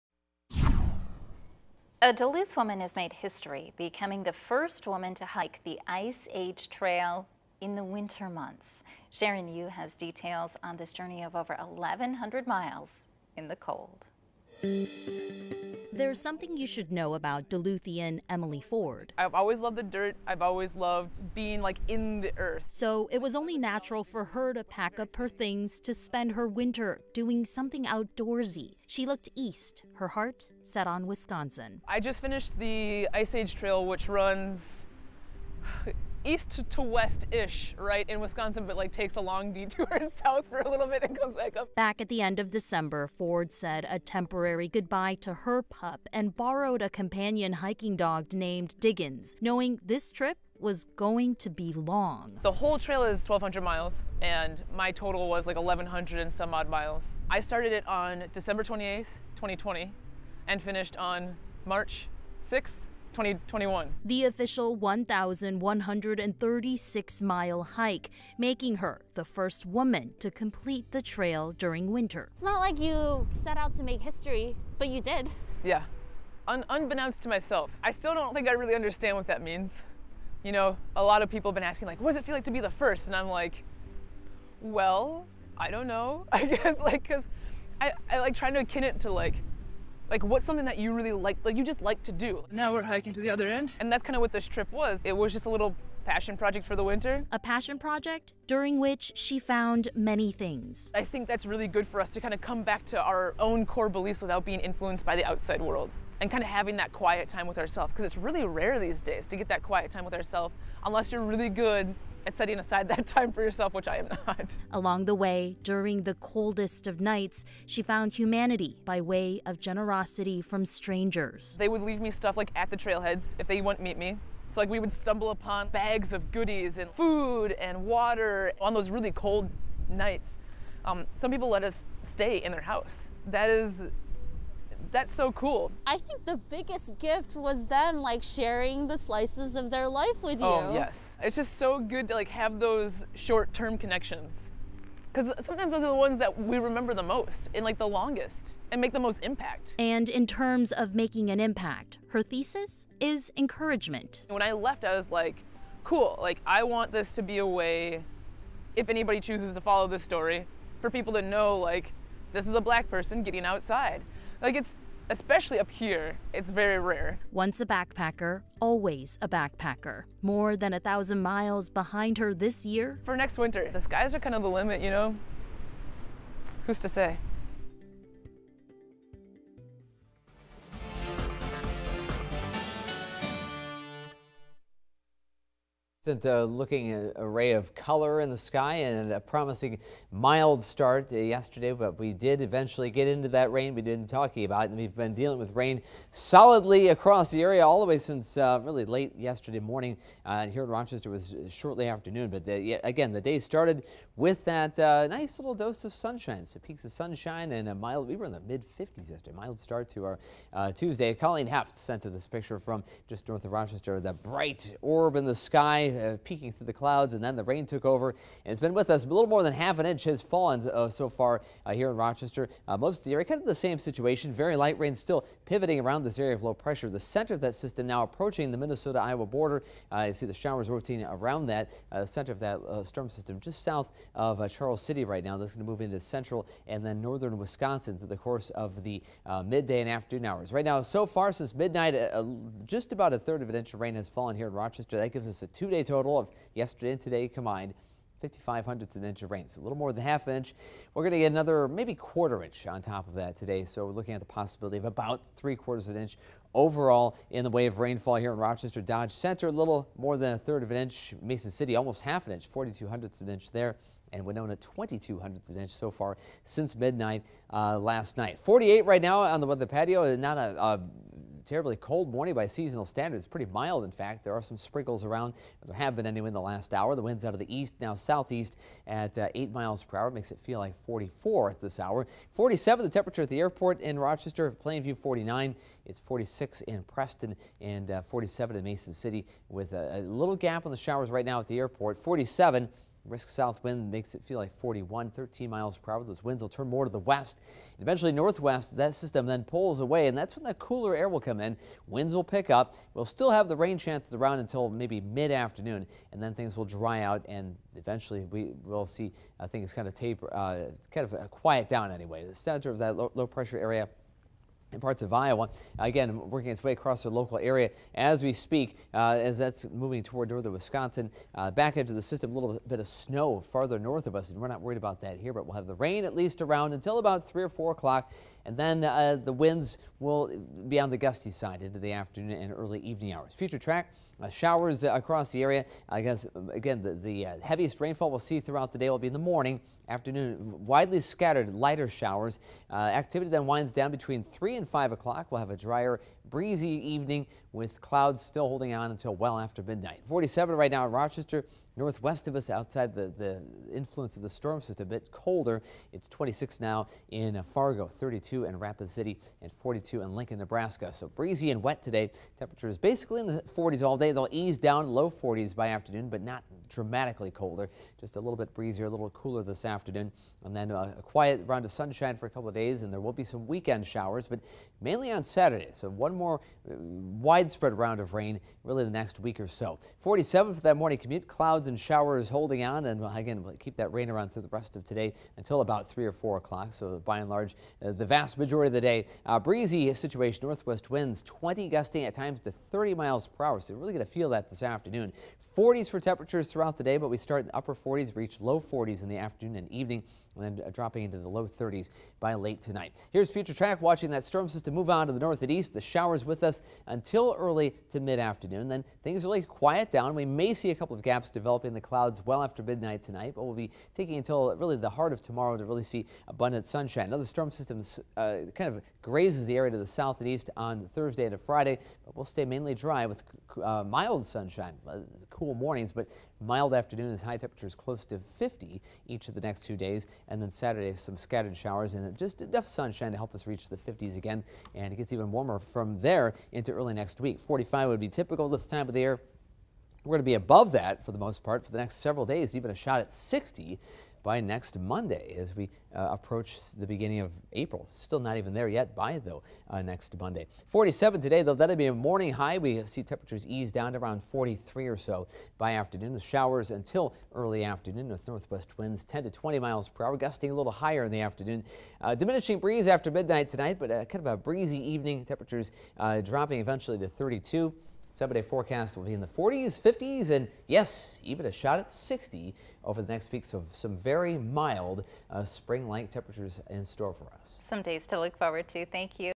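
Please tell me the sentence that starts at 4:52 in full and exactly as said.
47 Risk south wind makes it feel like 41, 13 miles per hour.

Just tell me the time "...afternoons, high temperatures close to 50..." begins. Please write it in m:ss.
7:06.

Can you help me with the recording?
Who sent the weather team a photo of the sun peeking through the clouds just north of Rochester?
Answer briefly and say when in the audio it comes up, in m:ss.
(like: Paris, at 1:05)
Colleen Heft, at 3:31.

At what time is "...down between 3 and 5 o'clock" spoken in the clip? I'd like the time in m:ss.
5:43.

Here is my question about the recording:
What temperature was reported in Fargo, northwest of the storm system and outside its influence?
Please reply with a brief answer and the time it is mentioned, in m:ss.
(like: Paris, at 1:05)
26, at 5:56.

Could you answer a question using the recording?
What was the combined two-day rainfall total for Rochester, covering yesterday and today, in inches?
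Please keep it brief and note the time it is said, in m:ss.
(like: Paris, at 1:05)
0.55 inches, at 4:08.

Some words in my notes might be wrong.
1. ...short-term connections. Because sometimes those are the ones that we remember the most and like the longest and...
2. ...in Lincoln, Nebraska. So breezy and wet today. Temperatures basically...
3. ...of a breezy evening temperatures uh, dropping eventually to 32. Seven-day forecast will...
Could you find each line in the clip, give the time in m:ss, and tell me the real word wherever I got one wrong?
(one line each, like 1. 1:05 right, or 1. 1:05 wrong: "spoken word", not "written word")
1. 2:23 right
2. 6:00 right
3. 7:44 right.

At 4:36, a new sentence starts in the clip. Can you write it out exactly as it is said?
The winds out of the east, now southeast at uh, 8 miles per hour.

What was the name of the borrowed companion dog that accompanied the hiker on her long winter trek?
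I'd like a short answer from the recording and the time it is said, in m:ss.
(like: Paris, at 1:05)
Diggins, at 0:48.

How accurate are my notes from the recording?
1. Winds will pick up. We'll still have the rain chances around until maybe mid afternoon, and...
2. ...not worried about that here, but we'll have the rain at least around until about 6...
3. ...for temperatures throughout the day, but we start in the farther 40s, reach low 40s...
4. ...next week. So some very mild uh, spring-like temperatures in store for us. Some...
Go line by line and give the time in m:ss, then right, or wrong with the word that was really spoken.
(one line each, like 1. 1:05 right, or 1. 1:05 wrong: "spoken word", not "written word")
1. 5:01 right
2. 5:24 wrong: "3", not "6"
3. 6:35 wrong: "upper", not "farther"
4. 7:53 right.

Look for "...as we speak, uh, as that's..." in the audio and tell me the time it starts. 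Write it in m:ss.
5:17.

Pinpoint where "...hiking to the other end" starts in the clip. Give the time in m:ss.
1:32.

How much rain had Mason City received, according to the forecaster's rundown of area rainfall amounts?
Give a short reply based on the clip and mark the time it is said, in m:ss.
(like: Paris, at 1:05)
0.42 inches, at 4:22.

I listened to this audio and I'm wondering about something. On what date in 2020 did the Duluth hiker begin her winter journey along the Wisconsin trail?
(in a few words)
December 28th.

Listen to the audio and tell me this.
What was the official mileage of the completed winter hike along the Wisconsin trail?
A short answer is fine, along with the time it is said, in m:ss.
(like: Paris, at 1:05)
1136, at 1:04.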